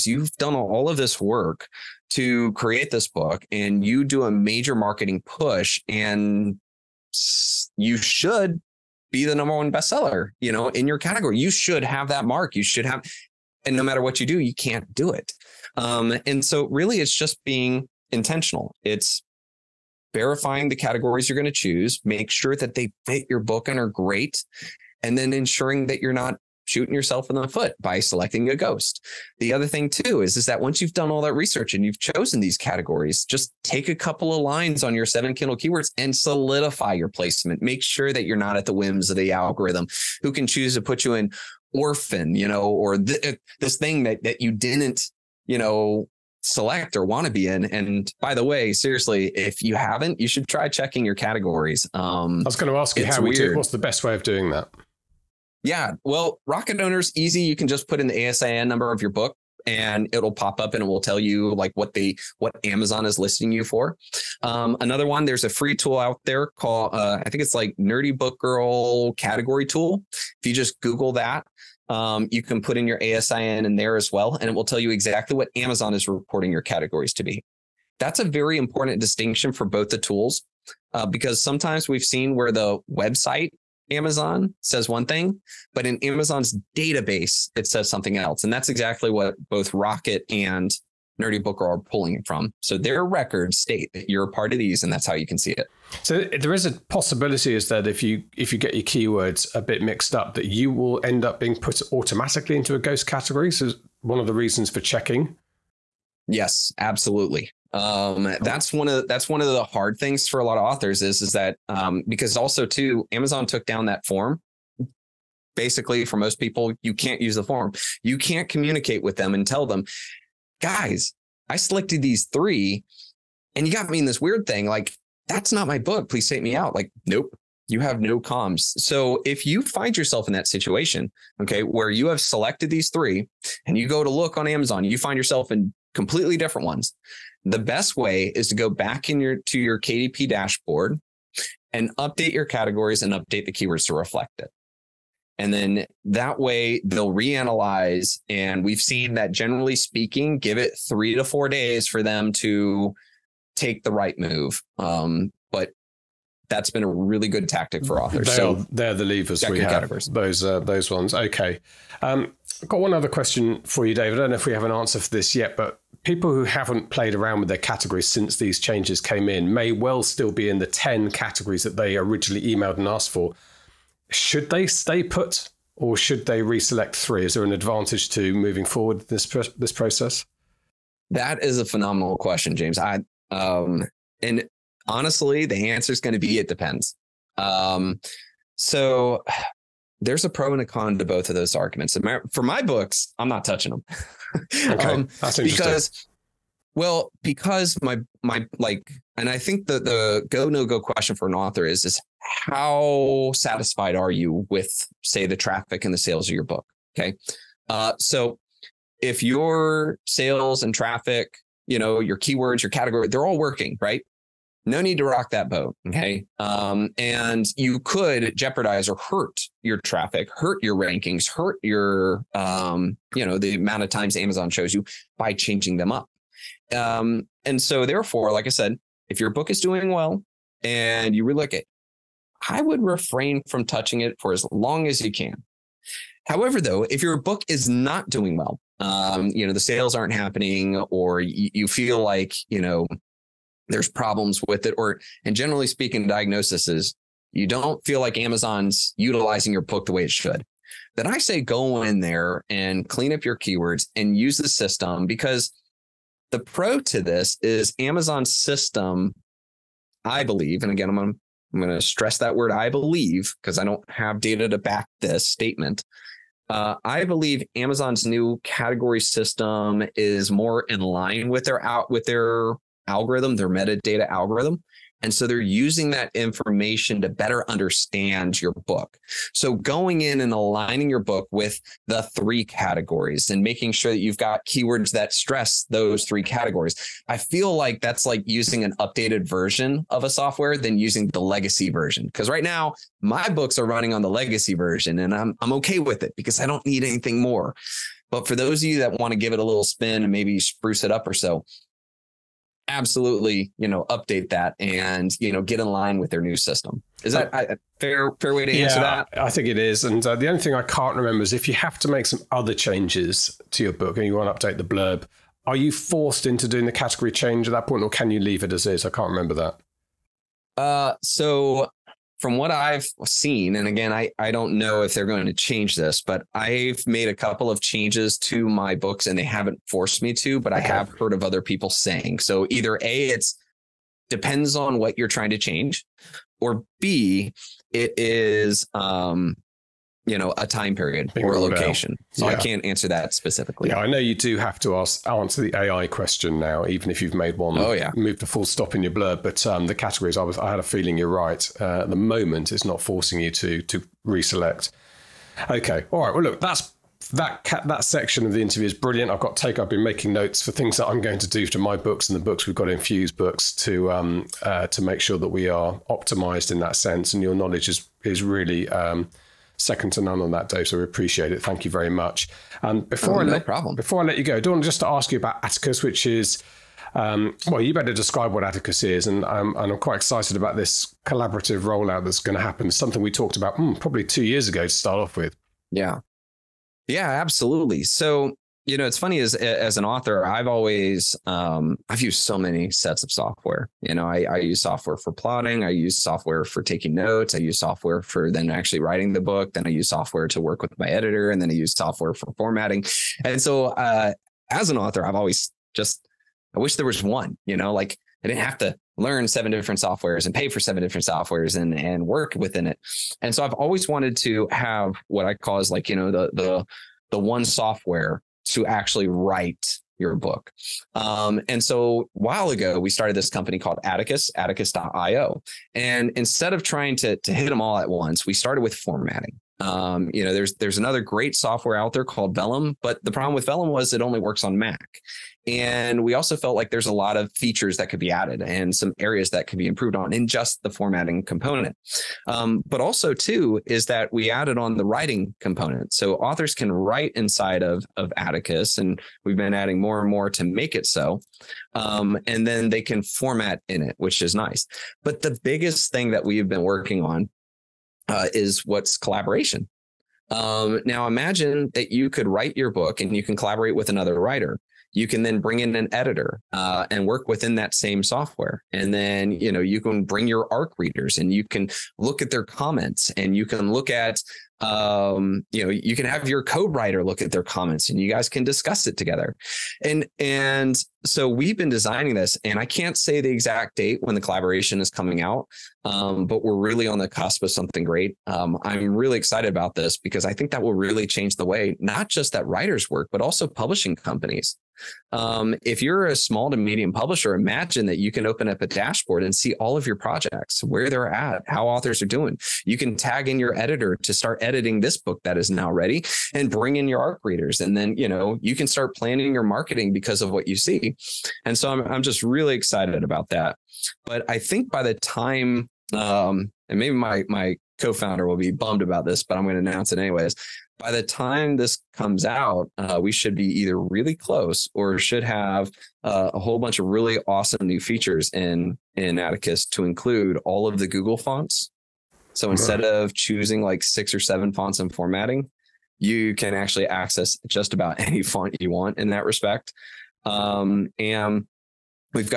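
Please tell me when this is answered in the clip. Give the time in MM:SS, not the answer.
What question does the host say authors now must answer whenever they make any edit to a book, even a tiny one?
05:45.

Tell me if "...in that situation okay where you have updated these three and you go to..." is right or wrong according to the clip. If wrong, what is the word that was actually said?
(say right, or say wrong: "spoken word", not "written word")
wrong: "selected", not "updated".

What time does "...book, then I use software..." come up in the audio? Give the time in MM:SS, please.
06:39.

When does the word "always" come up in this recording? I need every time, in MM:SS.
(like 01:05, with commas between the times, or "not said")
06:30, 06:45, 06:53.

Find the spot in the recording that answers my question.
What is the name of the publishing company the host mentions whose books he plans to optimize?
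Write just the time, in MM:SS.
06:02.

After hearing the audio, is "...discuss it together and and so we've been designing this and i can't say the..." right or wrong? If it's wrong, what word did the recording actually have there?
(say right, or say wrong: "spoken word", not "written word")
right.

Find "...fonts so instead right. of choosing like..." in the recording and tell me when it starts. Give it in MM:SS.
08:51.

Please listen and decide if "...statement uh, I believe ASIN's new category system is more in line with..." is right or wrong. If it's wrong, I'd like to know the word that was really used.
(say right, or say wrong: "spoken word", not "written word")
wrong: "Amazon", not "ASIN".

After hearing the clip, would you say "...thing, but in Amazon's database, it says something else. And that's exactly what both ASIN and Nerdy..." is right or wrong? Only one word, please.
wrong.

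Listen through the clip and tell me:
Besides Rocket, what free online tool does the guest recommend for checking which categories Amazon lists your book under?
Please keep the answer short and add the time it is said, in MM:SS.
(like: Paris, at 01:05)
Nerdy Book Girl category tool, at 01:07.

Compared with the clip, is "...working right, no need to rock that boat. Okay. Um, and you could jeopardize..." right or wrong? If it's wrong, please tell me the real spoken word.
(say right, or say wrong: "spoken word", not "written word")
right.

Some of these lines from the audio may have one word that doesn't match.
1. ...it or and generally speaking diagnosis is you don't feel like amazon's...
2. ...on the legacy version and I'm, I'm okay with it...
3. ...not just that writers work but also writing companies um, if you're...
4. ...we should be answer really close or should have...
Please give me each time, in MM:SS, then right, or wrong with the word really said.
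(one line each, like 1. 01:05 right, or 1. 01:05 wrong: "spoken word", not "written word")
1. 04:04 right
2. 04:53 right
3. 08:11 wrong: "publishing", not "writing"
4. 08:43 wrong: "either", not "answer".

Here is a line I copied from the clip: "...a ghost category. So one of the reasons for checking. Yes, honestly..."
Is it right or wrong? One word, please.
wrong.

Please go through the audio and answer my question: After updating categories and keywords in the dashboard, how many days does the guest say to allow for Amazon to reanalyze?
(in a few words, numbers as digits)
3 to 4.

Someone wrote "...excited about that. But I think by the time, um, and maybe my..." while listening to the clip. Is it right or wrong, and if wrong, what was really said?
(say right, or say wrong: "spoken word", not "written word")
right.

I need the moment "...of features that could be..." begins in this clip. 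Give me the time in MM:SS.
07:17.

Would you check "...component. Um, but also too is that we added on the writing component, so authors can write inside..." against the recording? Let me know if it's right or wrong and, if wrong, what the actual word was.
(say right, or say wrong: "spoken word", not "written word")
right.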